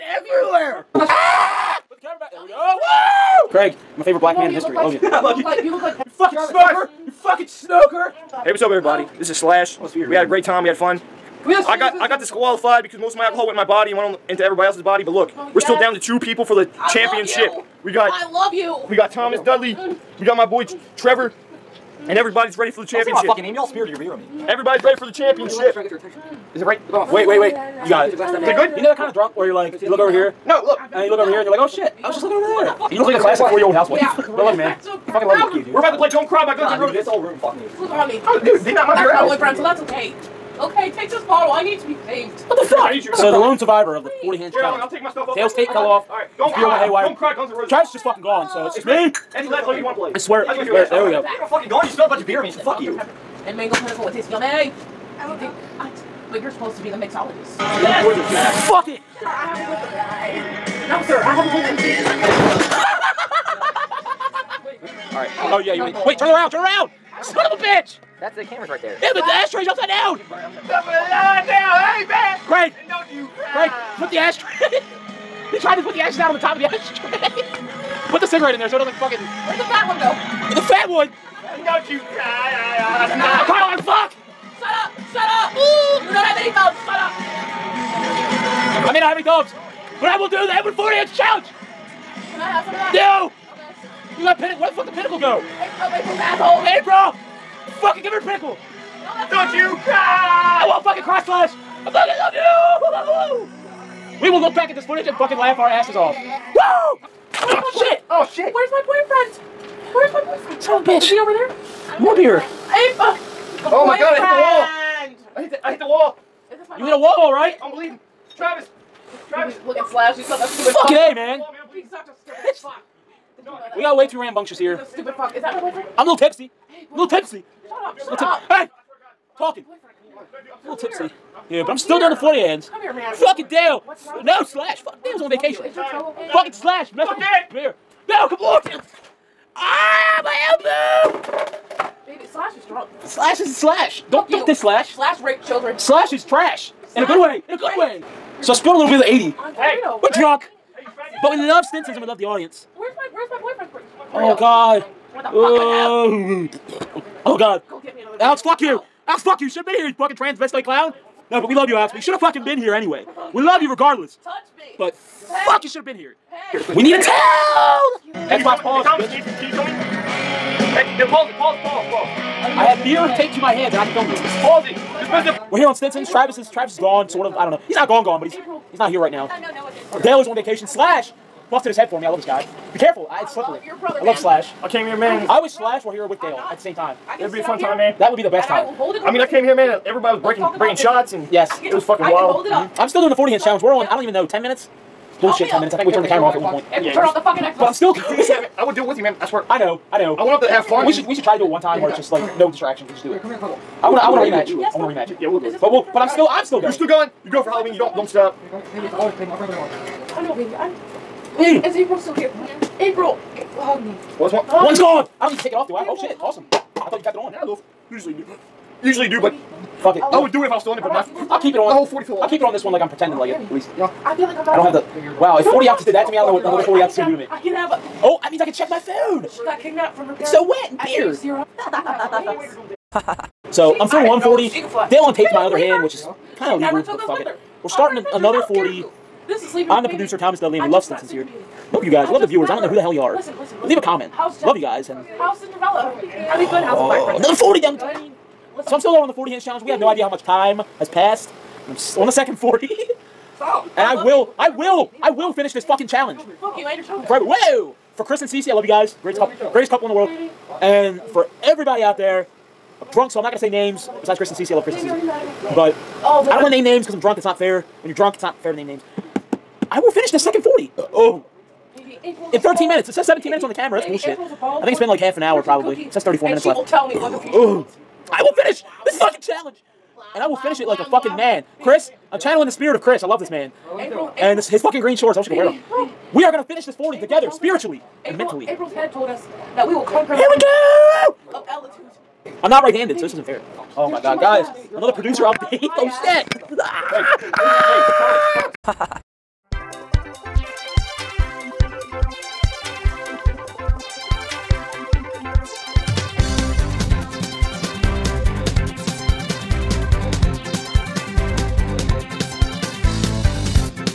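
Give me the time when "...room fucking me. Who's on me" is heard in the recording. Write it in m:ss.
0:37.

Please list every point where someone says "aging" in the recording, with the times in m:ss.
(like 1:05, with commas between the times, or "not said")
not said.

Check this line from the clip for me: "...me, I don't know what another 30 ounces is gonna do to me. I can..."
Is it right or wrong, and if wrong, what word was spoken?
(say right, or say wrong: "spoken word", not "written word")
wrong: "40", not "30".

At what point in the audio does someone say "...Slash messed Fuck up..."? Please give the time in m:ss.
2:16.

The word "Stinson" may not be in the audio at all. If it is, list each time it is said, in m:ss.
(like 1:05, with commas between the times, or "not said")
2:31, 2:55, 4:00.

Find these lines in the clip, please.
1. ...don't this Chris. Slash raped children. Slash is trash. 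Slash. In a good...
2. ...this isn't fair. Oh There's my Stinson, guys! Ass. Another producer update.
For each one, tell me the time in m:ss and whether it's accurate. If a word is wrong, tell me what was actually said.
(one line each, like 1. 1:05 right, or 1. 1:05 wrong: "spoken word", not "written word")
1. 2:24 wrong: "Slash", not "Chris"
2. 4:53 wrong: "God", not "Stinson".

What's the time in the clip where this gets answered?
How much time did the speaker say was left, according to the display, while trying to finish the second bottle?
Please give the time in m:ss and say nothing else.
4:36.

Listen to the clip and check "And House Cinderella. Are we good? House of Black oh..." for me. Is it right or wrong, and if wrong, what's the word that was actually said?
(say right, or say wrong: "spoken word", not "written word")
right.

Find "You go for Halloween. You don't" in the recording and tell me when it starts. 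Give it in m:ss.
3:27.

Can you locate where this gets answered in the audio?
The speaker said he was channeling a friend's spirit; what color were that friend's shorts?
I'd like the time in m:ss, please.
4:44.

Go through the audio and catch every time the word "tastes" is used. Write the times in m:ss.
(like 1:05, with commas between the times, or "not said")
0:54.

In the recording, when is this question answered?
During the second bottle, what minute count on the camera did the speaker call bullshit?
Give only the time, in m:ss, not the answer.
4:33.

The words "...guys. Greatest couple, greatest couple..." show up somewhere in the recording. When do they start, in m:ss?
4:18.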